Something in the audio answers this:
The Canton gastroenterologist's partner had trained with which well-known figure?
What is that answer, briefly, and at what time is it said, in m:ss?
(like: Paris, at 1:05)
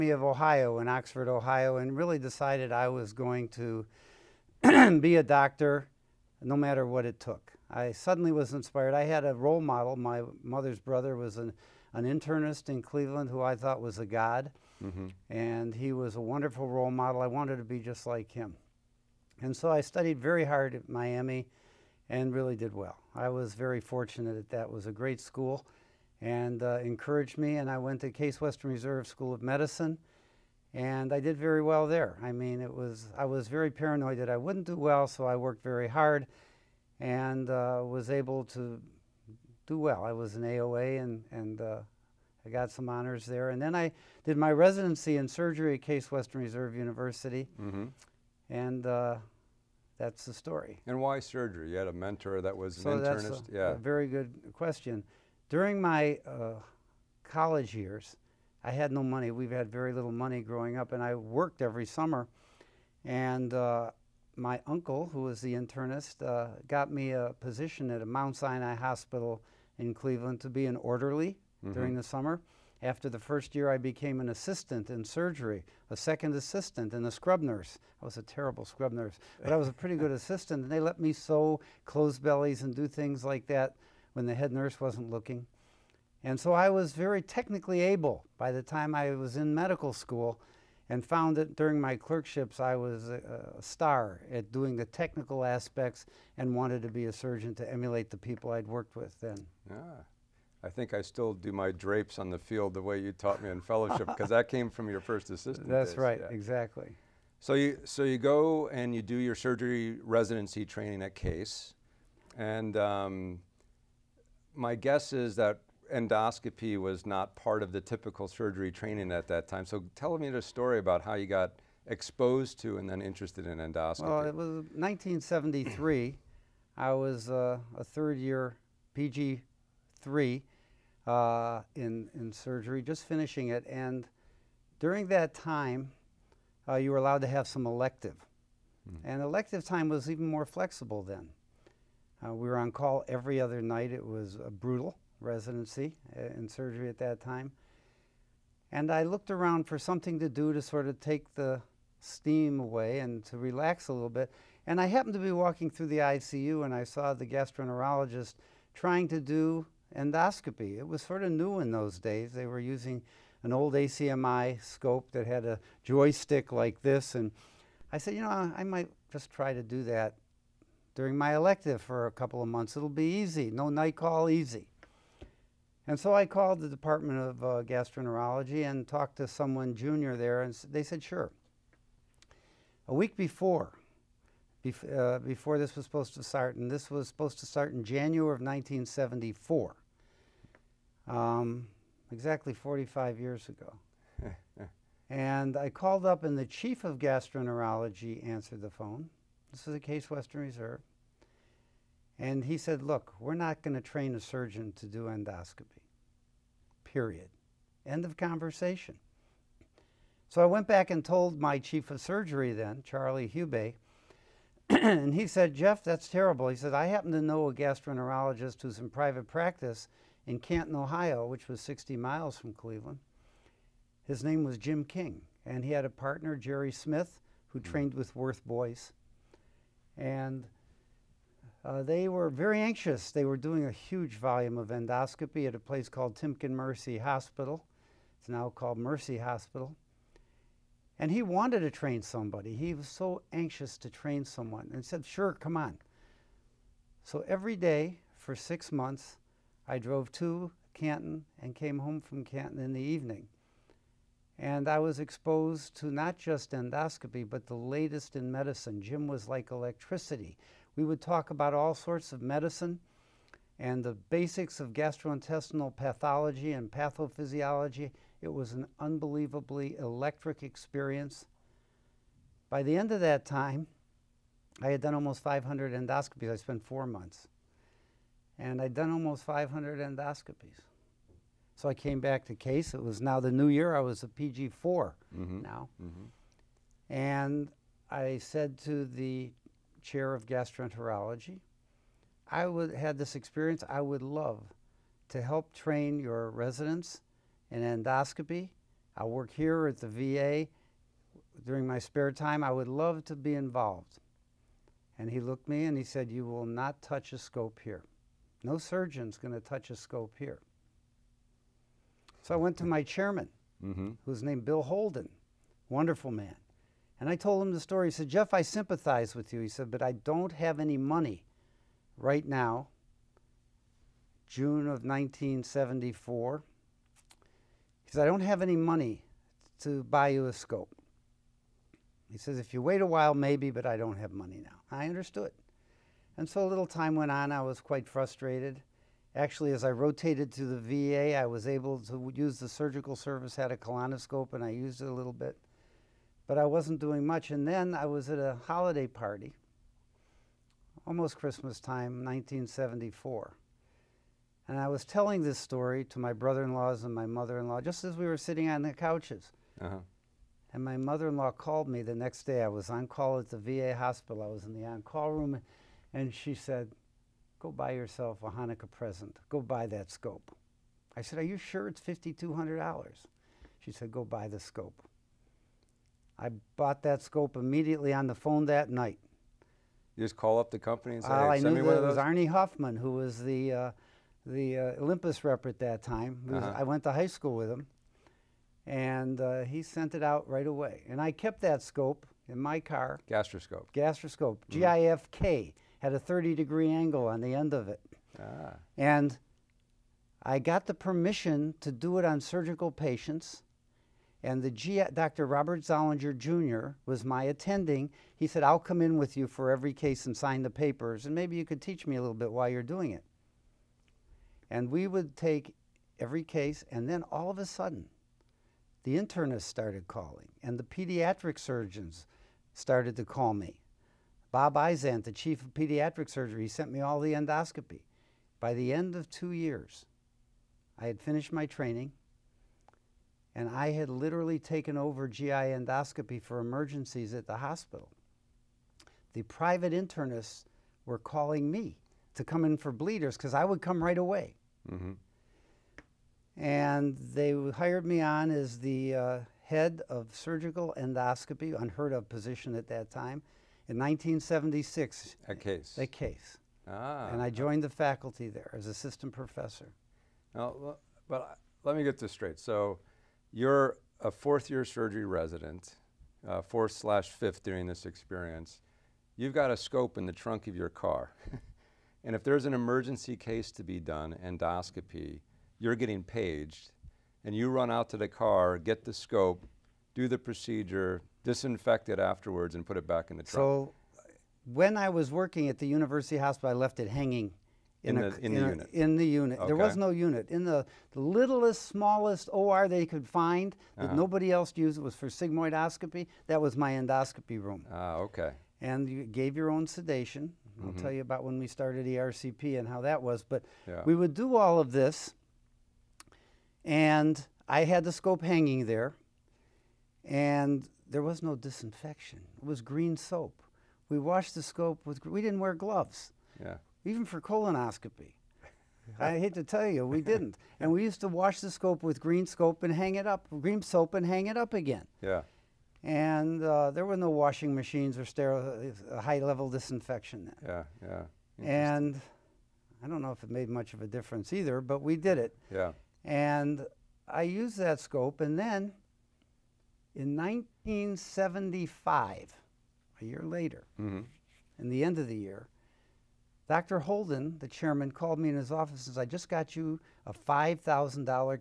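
Worth Boyce, at 3:48.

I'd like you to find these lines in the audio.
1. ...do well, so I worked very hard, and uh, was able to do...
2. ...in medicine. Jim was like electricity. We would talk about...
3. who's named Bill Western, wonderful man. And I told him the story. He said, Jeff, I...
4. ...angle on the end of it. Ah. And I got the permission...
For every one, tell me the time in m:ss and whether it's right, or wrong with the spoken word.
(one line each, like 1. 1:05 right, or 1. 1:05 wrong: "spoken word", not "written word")
1. 0:34 right
2. 4:18 right
3. 5:14 wrong: "Holden", not "Western"
4. 6:36 right.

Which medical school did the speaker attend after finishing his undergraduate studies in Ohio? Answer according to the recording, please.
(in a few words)
Case Western Reserve School of Medicine.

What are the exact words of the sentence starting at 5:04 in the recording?
And he looked me and he said, You will not touch a scope here.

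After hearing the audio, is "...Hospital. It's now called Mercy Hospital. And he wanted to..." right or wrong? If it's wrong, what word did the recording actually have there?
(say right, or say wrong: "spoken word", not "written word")
right.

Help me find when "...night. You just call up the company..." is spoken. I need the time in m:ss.
6:18.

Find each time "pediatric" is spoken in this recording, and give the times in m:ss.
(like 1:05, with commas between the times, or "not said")
7:00, 7:05.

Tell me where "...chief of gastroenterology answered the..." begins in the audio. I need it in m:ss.
3:16.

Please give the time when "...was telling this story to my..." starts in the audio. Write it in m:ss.
5:54.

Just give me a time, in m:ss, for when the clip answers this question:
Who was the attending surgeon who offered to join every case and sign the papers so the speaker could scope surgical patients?
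6:45.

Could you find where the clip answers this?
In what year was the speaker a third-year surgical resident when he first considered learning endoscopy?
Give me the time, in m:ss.
2:04.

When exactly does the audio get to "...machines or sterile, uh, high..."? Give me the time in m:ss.
8:47.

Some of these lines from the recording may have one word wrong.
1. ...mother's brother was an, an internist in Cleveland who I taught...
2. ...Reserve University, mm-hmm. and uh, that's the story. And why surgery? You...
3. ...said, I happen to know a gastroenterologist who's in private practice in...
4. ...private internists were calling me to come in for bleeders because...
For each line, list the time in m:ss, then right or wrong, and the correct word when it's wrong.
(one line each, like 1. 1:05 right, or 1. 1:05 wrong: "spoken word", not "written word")
1. 0:10 wrong: "thought", not "taught"
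2. 0:46 right
3. 3:36 right
4. 7:19 right.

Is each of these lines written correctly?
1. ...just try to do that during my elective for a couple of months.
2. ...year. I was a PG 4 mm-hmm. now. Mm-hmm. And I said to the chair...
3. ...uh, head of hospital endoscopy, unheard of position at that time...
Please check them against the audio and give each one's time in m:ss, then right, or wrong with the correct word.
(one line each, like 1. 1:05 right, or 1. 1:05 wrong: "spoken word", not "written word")
1. 2:49 right
2. 4:43 right
3. 7:28 wrong: "surgical", not "hospital".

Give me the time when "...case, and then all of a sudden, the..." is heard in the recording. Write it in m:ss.
6:56.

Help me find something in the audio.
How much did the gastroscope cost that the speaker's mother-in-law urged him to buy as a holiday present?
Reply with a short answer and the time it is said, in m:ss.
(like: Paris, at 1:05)
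$5,200, at 6:11.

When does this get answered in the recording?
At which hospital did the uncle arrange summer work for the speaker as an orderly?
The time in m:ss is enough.
1:08.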